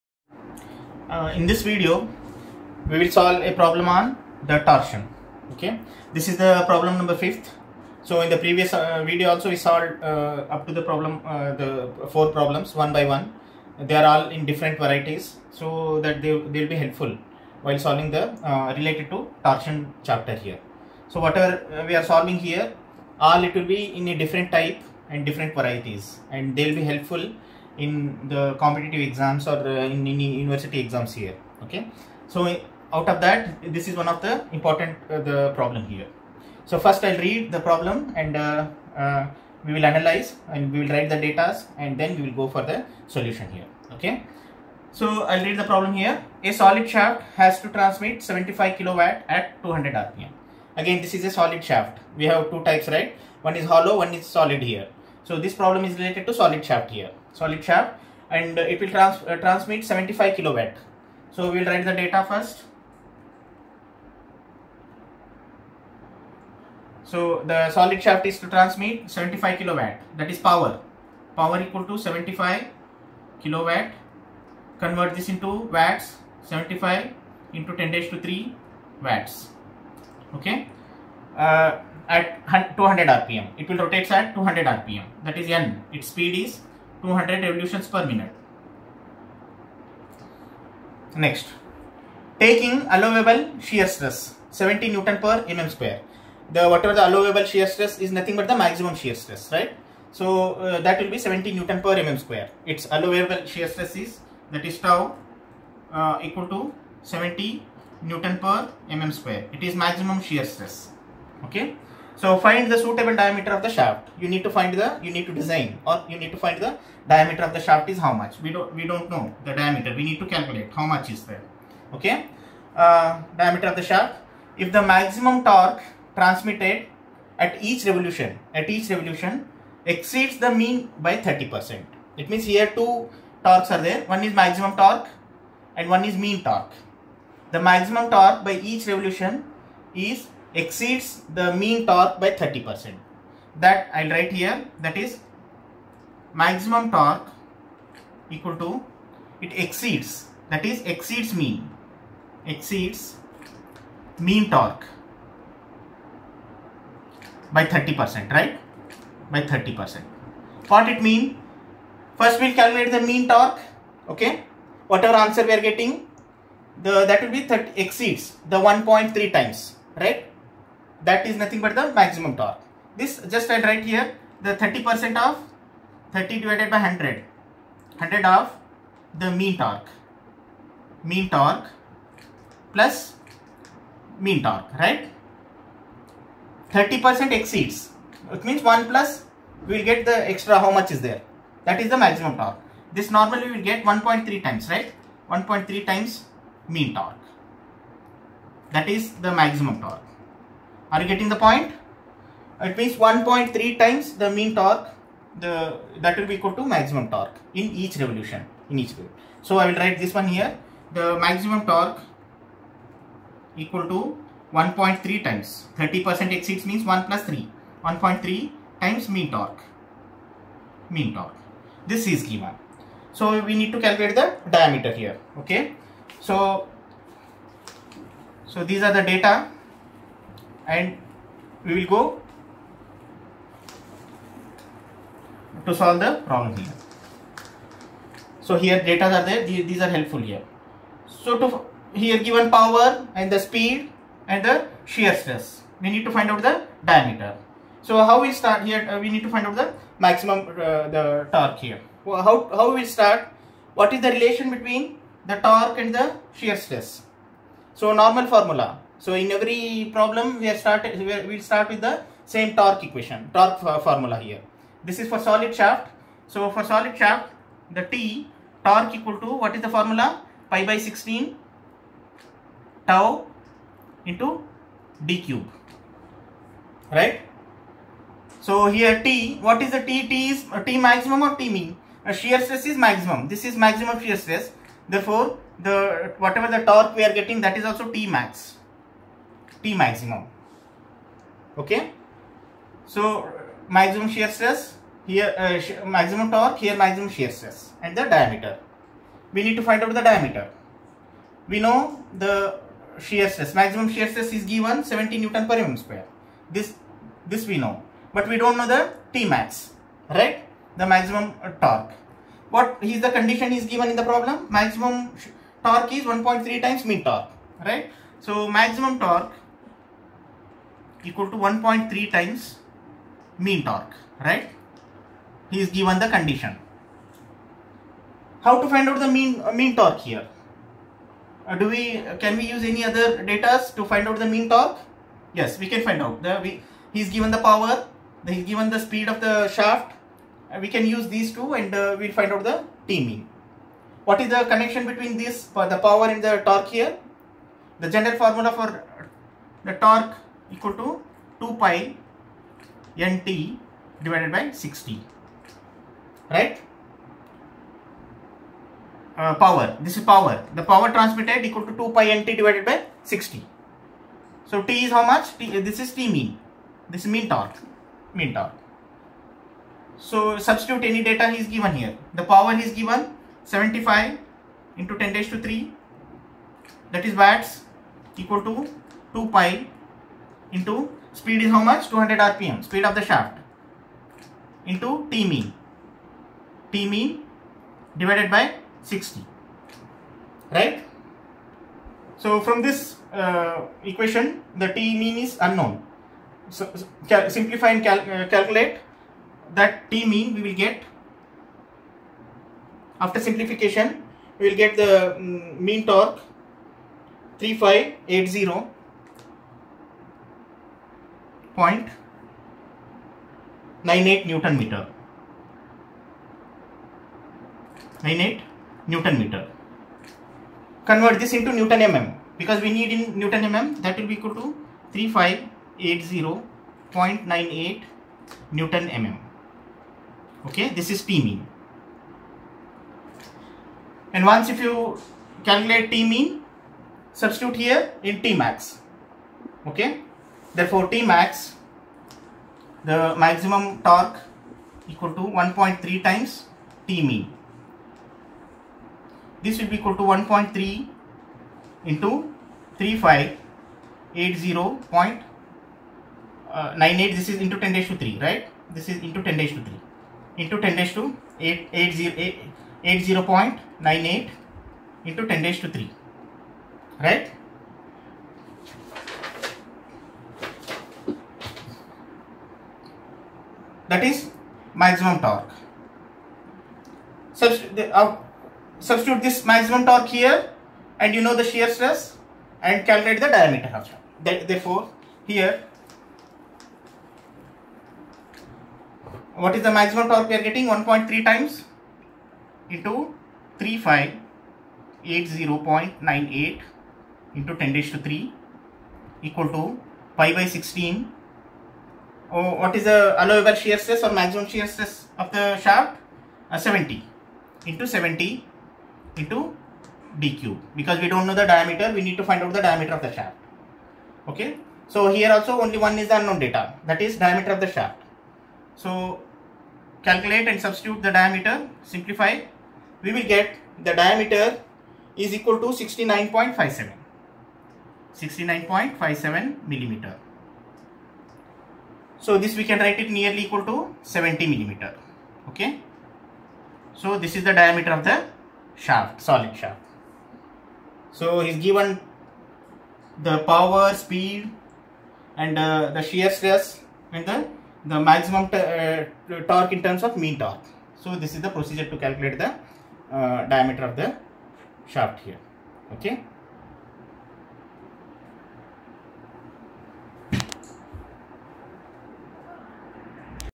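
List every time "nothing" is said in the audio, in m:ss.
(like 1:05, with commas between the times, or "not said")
1:38, 2:51.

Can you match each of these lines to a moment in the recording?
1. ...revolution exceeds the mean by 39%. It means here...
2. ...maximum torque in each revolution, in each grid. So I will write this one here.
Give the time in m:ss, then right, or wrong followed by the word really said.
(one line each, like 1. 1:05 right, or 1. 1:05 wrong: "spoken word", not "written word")
1. 2:08 wrong: "30", not "39"
2. 3:26 right.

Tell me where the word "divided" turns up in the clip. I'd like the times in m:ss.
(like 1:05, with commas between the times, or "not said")
2:56, 5:54, 6:02, 6:27.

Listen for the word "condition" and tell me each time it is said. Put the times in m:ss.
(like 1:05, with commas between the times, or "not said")
5:13, 5:26.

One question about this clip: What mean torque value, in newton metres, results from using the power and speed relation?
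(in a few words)
3580.98.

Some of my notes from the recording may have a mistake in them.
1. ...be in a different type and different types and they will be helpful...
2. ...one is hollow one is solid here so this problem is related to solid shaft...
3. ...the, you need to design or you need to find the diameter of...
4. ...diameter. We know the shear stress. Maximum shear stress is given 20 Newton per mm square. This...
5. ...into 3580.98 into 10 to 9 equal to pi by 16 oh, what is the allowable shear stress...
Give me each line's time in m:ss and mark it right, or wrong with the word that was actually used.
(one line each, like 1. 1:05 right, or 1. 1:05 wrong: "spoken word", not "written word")
1. 0:23 wrong: "varieties", not "types"
2. 0:53 right
3. 1:54 right
4. 5:00 wrong: "70", not "20"
5. 8:12 wrong: "3", not "9".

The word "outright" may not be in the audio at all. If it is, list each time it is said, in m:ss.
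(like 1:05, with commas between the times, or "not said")
not said.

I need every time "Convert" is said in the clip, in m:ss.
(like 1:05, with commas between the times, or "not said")
1:14, 7:00.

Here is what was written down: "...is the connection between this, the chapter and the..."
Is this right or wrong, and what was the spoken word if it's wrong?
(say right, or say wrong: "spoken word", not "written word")
wrong: "power", not "chapter".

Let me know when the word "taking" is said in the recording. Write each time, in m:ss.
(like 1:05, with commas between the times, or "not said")
1:32.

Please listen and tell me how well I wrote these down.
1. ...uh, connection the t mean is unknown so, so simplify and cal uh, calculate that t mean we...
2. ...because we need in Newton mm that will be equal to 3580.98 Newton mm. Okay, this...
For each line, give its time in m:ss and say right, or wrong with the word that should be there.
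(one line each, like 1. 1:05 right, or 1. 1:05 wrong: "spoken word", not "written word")
1. 6:33 wrong: "equation", not "connection"
2. 7:02 right.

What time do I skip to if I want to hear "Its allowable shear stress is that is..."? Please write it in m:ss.
1:42.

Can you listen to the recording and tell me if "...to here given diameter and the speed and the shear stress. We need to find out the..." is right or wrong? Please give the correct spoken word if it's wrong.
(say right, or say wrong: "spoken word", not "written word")
wrong: "power", not "diameter".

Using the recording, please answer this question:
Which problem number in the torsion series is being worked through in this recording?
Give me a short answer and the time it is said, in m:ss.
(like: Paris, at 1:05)
5, at 0:06.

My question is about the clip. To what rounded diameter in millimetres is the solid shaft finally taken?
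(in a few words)
70 mm.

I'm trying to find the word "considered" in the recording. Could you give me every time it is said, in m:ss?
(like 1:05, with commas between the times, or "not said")
not said.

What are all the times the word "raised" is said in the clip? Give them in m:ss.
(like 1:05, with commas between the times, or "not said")
6:15.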